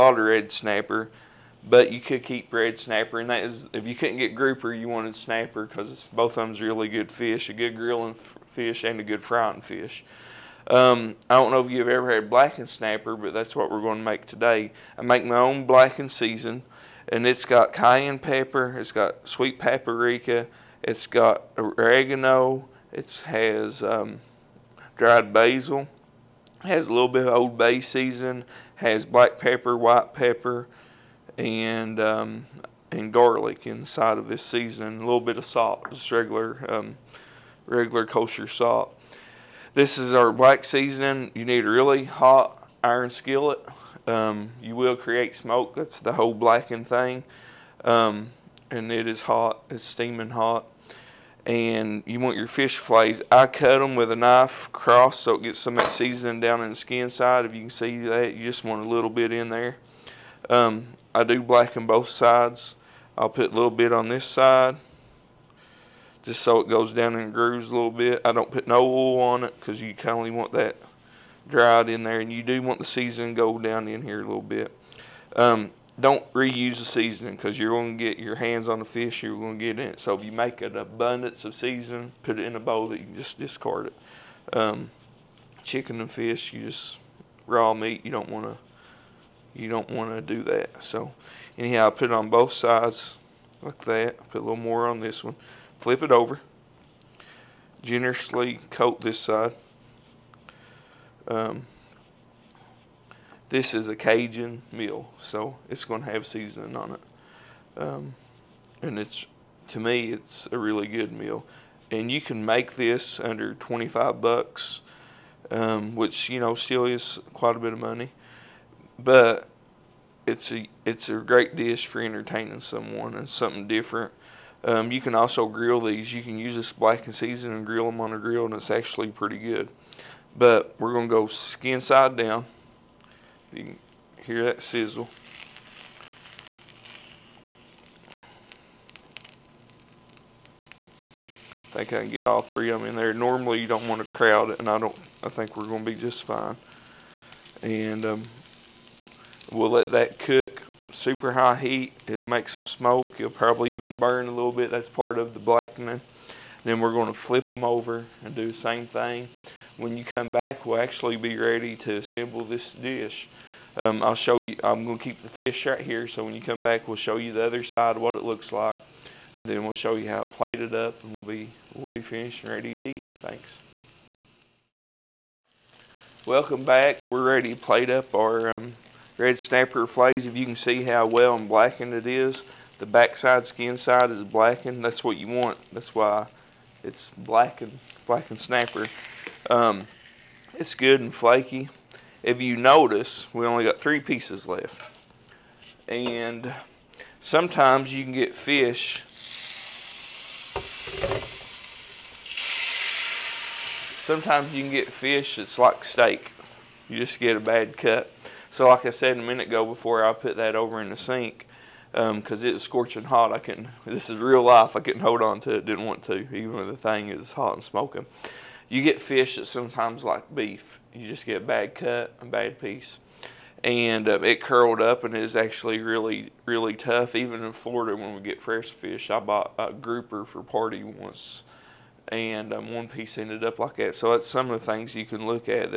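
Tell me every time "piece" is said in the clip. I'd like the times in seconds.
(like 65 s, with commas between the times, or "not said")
194 s, 222 s, 232 s.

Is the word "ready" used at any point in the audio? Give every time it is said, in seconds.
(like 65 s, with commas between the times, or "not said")
161 s, 172 s, 177 s.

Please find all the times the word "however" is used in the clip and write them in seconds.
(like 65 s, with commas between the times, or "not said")
not said.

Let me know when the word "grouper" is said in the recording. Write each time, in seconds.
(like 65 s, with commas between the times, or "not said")
4 s, 229 s.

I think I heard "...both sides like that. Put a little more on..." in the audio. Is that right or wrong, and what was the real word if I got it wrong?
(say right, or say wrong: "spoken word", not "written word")
right.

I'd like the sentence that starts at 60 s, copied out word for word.
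Um, I do blacken both sides.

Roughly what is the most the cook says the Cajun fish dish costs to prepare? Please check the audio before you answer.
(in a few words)
$25.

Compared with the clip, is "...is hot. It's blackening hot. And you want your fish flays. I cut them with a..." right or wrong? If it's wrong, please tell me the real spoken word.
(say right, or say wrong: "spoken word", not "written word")
wrong: "steaming", not "blackening".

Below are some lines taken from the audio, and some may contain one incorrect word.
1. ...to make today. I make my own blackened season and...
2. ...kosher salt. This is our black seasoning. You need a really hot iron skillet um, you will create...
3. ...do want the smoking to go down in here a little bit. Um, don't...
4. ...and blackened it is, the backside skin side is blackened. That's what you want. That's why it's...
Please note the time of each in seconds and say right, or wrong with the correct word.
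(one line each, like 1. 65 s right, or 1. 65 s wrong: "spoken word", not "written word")
1. 13 s right
2. 38 s right
3. 72 s wrong: "seasoning", not "smoking"
4. 181 s right.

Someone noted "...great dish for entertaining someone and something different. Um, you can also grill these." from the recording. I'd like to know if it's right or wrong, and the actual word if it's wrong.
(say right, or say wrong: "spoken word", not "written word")
right.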